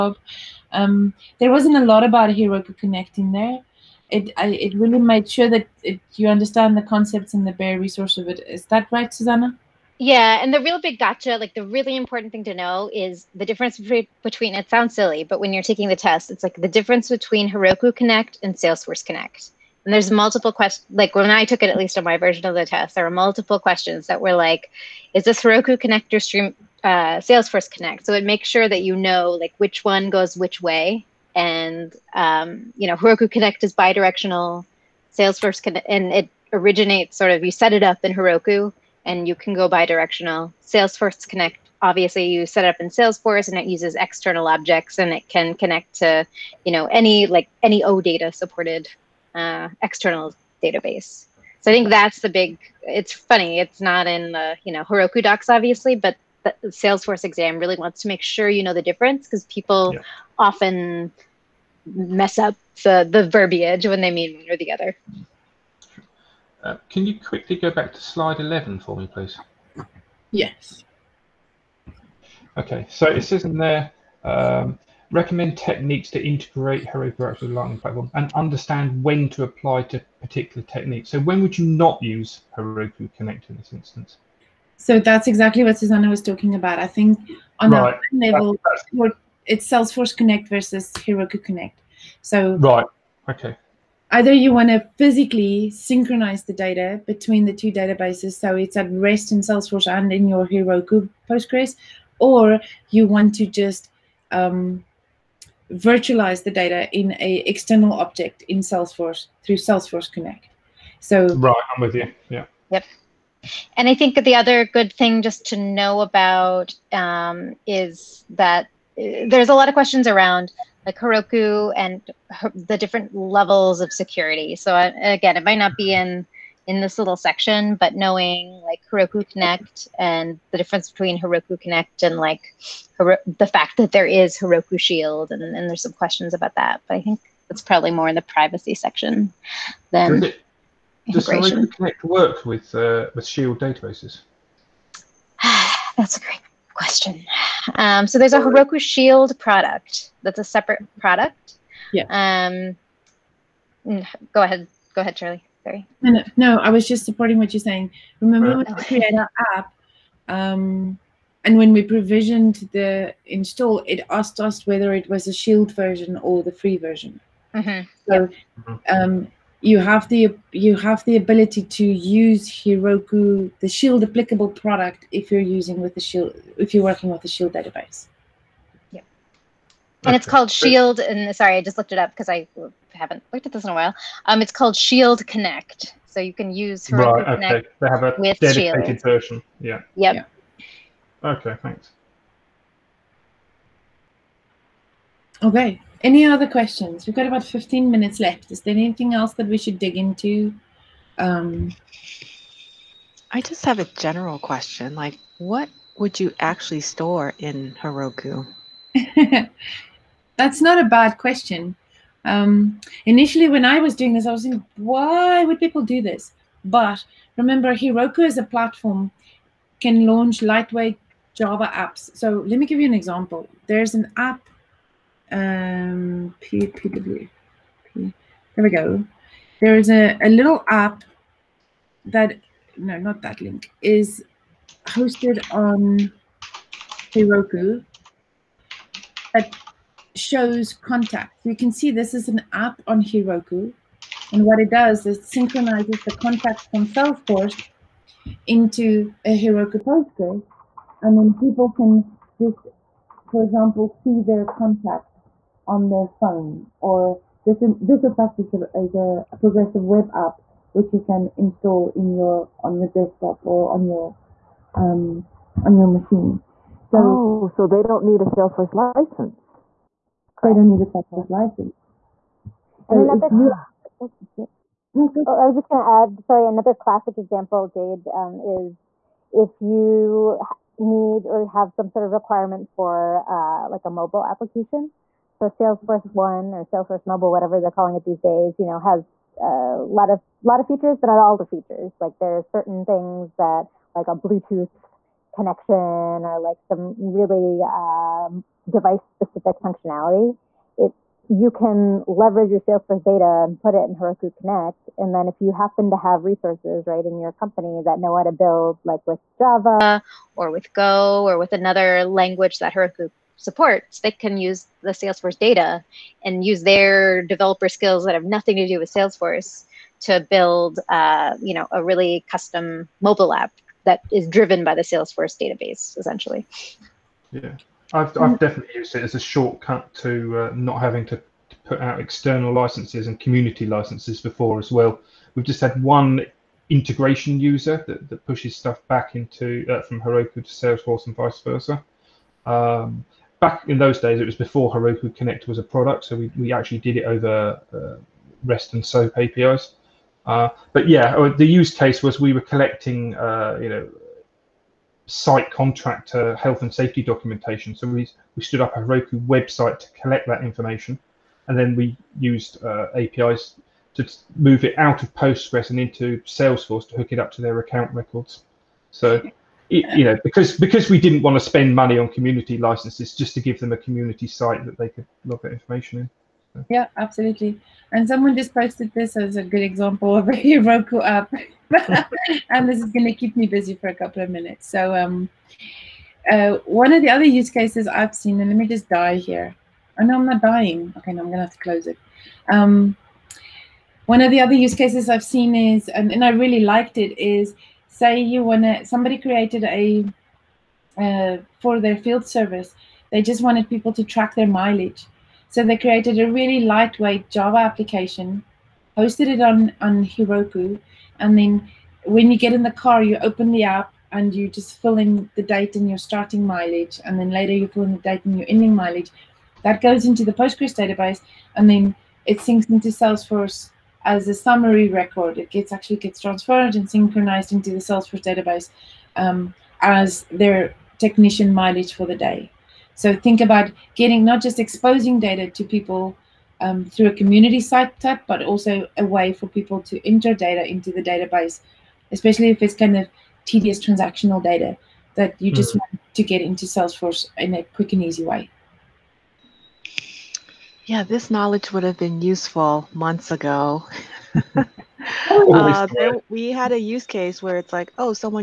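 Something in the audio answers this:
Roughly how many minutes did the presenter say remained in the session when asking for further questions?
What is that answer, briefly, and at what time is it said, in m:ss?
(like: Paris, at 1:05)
15 minutes, at 3:17.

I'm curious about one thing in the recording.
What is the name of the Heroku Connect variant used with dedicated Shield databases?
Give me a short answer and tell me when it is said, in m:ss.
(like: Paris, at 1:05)
Shield Connect, at 3:04.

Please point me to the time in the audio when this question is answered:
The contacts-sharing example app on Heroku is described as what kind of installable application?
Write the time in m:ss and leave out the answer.
4:19.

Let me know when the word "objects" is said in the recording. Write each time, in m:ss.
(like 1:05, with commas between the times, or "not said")
0:44, 1:47.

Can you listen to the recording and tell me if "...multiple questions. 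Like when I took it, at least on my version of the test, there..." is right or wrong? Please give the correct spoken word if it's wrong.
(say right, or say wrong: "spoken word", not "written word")
right.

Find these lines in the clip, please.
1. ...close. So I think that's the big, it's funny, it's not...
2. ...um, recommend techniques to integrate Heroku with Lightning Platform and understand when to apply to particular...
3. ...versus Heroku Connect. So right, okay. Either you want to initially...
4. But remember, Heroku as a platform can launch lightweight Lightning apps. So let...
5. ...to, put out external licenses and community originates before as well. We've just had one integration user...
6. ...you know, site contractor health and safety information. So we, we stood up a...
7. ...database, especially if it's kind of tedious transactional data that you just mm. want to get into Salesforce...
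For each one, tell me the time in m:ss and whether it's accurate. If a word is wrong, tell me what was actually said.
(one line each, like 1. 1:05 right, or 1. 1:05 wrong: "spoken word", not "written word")
1. 0:50 wrong: "database", not "close"
2. 1:14 right
3. 1:30 wrong: "physically", not "initially"
4. 3:36 wrong: "Java", not "Lightning"
5. 5:31 wrong: "licenses", not "originates"
6. 5:53 wrong: "documentation", not "information"
7. 7:21 right.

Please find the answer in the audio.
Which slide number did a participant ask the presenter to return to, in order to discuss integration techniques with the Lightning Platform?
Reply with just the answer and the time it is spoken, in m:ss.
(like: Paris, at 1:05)
11, at 1:08.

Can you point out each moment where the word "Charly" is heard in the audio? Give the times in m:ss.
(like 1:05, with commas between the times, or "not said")
2:35.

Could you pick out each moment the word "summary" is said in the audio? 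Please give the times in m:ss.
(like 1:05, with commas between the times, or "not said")
7:04.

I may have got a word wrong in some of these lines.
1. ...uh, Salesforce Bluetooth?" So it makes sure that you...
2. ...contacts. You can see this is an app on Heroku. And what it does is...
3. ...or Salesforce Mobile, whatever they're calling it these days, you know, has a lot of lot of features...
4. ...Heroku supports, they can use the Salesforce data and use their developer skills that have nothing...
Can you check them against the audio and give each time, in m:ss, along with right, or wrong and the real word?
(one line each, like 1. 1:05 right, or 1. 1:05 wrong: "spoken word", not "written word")
1. 0:26 wrong: "Connect", not "Bluetooth"
2. 4:00 right
3. 4:46 right
4. 5:12 right.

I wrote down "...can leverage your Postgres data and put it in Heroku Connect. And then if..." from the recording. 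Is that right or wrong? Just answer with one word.
wrong.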